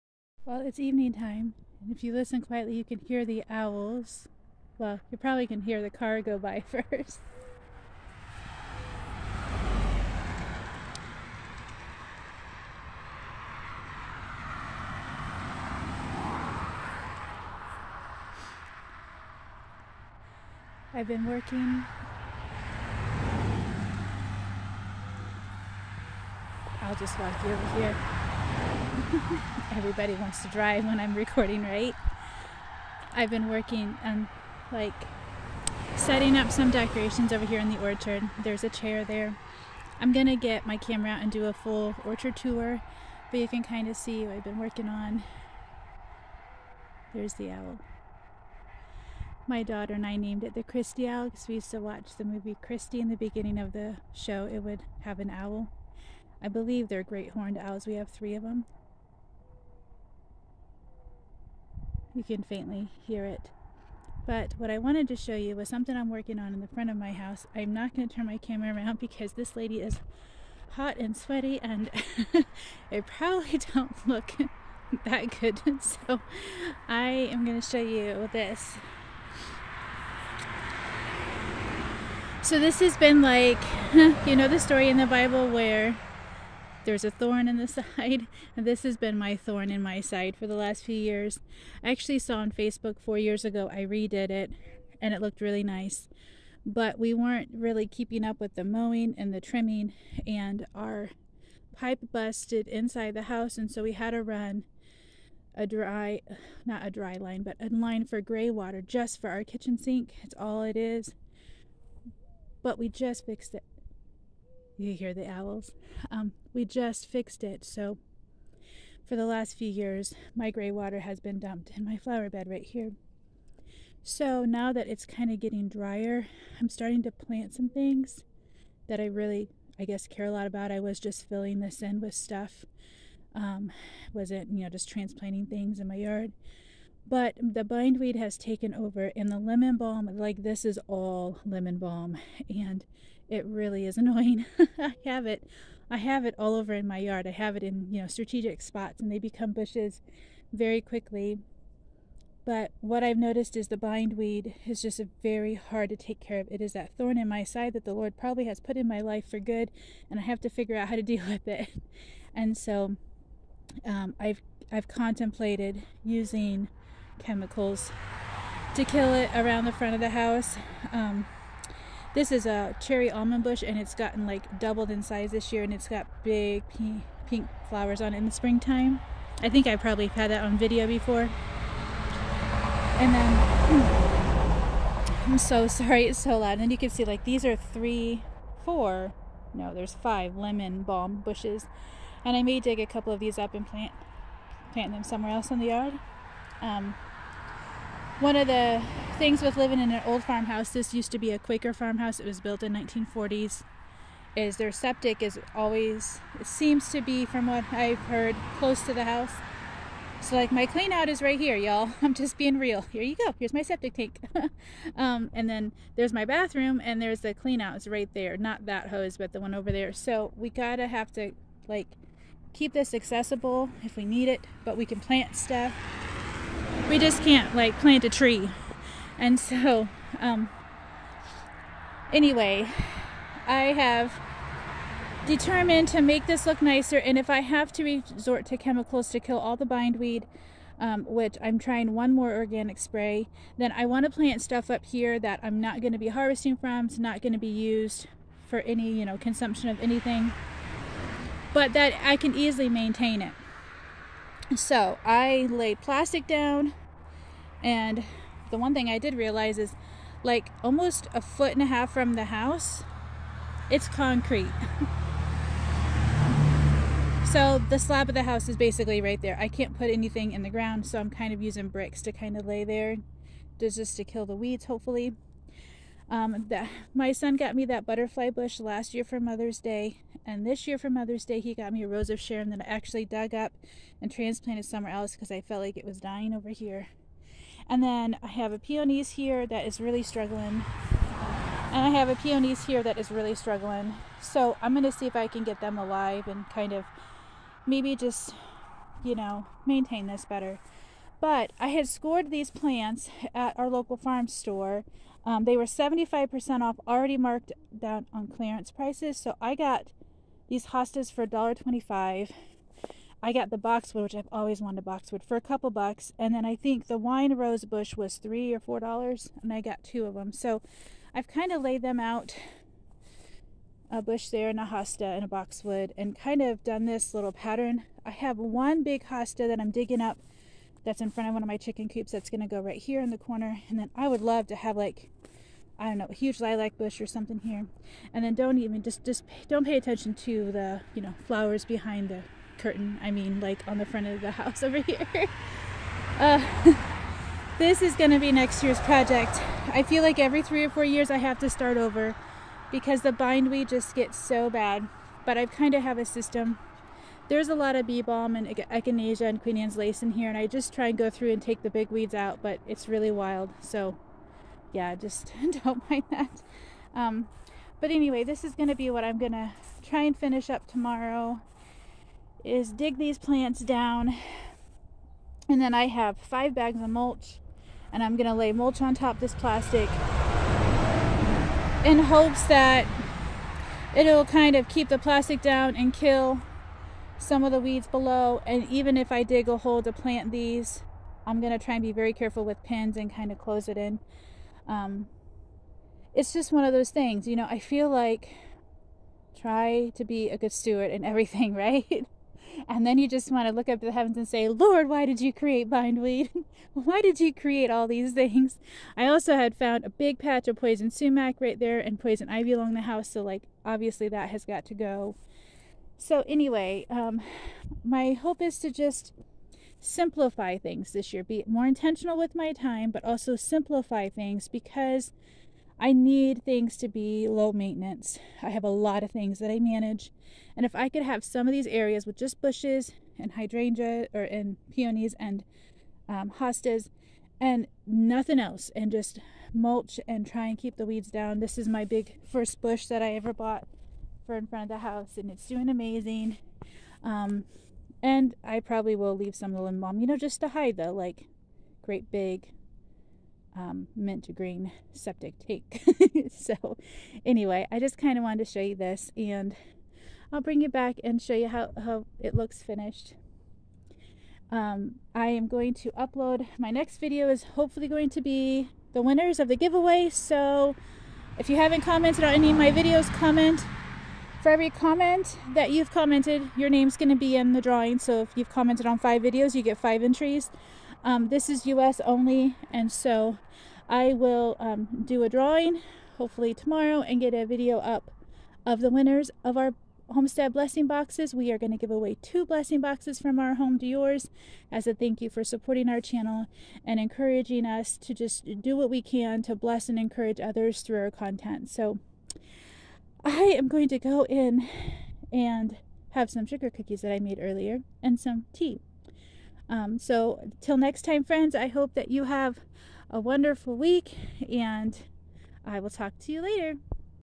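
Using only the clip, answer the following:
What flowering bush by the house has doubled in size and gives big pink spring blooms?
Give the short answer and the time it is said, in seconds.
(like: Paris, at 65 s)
cherry almond, at 172 s.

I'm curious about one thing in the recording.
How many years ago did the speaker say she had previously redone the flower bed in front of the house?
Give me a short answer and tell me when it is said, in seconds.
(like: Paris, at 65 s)
4, at 92 s.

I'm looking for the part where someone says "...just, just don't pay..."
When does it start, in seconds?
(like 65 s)
338 s.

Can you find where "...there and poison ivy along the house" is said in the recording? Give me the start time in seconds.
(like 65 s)
411 s.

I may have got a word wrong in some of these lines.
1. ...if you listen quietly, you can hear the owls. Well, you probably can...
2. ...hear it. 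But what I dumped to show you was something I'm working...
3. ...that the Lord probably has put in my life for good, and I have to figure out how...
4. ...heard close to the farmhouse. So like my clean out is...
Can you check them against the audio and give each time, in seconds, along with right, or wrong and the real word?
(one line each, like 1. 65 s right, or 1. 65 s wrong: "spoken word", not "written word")
1. 1 s right
2. 63 s wrong: "wanted", not "dumped"
3. 157 s right
4. 207 s wrong: "house", not "farmhouse".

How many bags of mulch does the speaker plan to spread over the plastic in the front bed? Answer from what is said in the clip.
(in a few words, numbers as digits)
5.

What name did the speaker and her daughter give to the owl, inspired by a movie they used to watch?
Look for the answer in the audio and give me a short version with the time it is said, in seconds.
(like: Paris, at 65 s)
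Christy Owl, at 50 s.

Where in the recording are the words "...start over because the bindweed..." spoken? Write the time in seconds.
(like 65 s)
351 s.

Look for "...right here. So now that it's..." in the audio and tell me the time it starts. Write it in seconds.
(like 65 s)
122 s.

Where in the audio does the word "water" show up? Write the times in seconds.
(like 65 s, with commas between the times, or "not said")
108 s, 120 s.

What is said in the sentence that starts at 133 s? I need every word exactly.
Um, wasn't, you know, just transplanting things in my yard.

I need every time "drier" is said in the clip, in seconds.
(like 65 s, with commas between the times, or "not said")
125 s.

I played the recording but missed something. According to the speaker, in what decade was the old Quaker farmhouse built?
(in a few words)
1940s.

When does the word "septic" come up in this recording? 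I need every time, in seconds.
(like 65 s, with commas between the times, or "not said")
204 s, 213 s, 454 s.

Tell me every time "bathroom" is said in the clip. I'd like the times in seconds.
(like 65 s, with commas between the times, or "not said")
216 s.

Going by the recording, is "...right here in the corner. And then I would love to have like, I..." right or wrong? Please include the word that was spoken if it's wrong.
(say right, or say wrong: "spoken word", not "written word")
right.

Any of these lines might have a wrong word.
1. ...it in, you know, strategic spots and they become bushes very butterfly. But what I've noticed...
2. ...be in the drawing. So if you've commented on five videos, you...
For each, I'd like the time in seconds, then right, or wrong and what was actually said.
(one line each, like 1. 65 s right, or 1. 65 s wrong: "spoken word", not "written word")
1. 147 s wrong: "quickly", not "butterfly"
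2. 477 s right.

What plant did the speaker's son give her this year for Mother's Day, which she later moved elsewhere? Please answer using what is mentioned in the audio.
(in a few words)
rose of Sharon.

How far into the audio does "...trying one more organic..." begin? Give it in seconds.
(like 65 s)
241 s.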